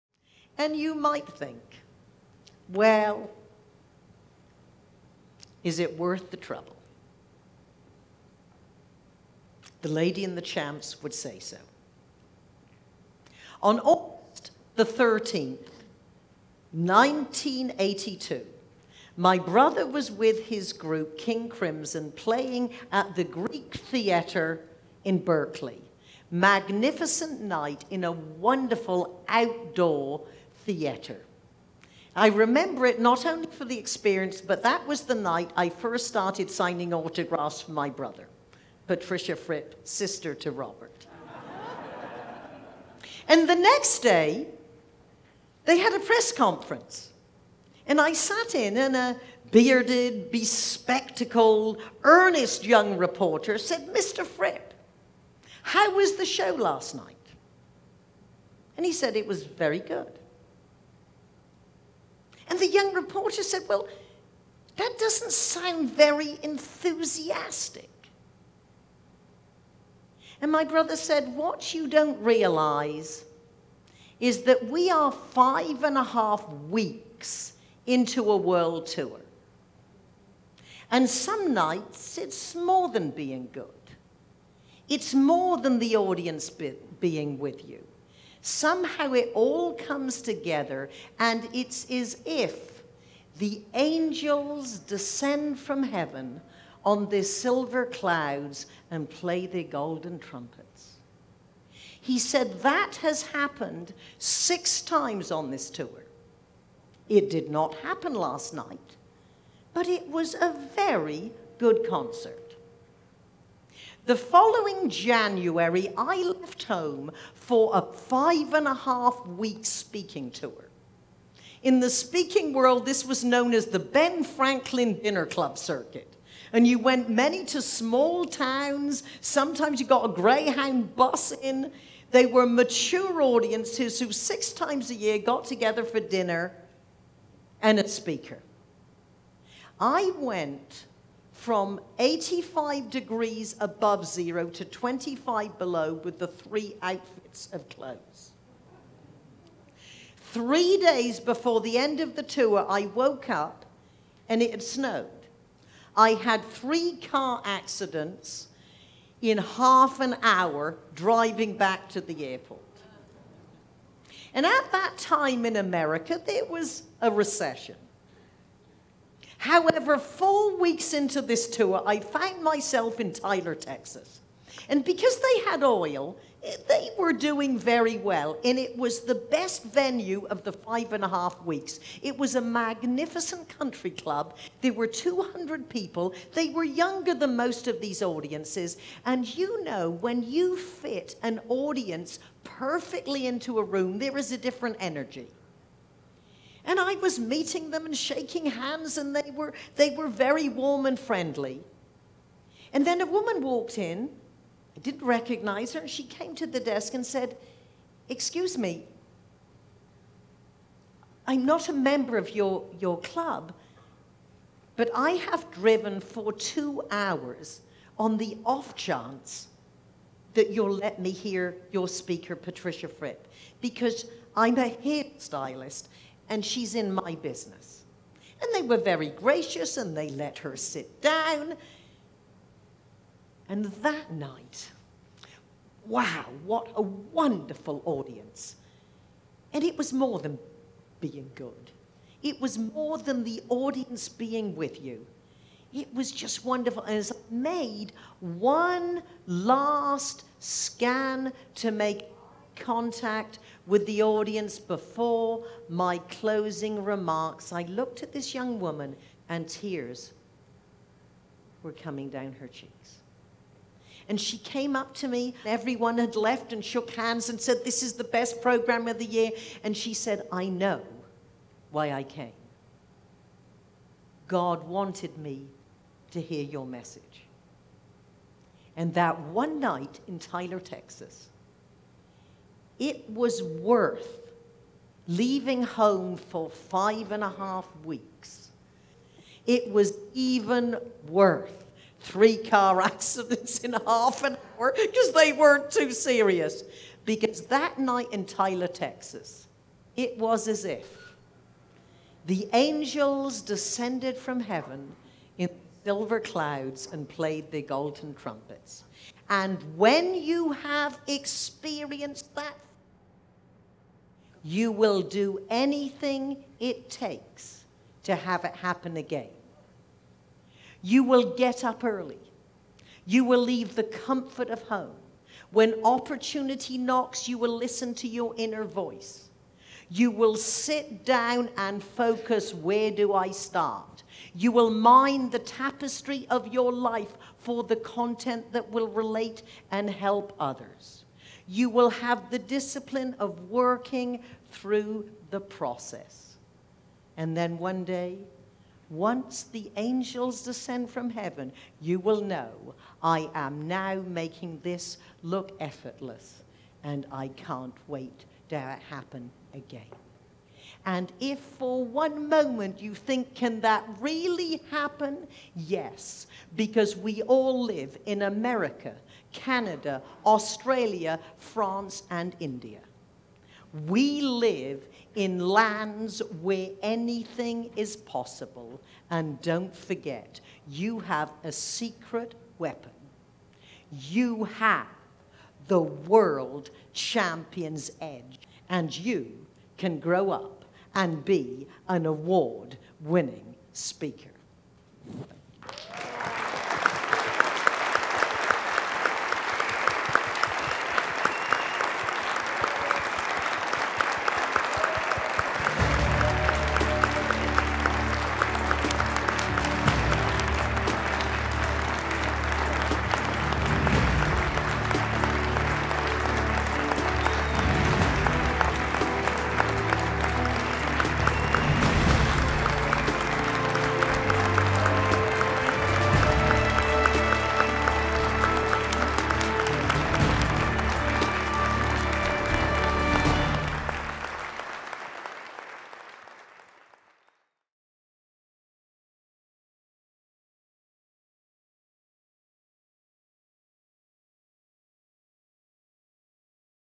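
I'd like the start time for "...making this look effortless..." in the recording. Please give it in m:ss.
5:54.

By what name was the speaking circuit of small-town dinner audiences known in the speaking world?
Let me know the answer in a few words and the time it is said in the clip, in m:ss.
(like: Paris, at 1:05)
Ben Franklin Dinner Club Circuit, at 2:03.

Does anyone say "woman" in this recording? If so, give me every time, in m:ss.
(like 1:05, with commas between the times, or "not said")
3:23, 4:18.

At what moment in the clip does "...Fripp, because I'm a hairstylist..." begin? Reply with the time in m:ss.
3:42.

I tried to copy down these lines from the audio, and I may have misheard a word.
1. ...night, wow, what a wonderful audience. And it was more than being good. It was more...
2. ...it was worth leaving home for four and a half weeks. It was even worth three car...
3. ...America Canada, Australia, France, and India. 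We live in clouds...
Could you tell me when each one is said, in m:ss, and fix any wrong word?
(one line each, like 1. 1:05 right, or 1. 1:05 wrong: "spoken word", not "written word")
1. 3:54 right
2. 4:42 wrong: "five", not "four"
3. 6:08 wrong: "lands", not "clouds".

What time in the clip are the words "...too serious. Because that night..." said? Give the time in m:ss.
4:55.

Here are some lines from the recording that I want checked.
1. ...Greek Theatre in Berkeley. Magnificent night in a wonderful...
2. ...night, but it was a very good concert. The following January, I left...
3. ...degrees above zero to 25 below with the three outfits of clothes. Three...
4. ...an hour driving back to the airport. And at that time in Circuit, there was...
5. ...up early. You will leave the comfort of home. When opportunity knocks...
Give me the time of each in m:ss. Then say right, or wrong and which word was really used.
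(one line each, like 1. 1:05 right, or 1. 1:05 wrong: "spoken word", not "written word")
1. 0:23 right
2. 1:48 right
3. 2:22 right
4. 2:39 wrong: "America", not "Circuit"
5. 5:21 right.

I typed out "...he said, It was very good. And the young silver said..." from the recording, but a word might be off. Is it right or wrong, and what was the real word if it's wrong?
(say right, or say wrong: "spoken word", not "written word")
wrong: "reporter", not "silver".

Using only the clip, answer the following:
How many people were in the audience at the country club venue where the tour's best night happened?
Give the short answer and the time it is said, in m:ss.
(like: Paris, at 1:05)
200, at 3:04.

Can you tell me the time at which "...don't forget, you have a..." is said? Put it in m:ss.
6:19.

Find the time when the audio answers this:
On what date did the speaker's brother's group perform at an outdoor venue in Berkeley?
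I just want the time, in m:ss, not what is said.
0:13.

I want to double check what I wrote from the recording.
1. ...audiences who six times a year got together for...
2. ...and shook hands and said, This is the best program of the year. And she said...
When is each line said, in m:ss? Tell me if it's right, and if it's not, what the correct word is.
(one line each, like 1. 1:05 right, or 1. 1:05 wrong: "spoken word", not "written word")
1. 2:13 right
2. 4:26 right.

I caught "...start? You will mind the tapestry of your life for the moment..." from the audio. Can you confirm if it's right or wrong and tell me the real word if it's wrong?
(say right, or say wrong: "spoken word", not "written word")
wrong: "content", not "moment".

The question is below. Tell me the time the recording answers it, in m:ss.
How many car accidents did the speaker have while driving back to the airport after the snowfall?
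2:36.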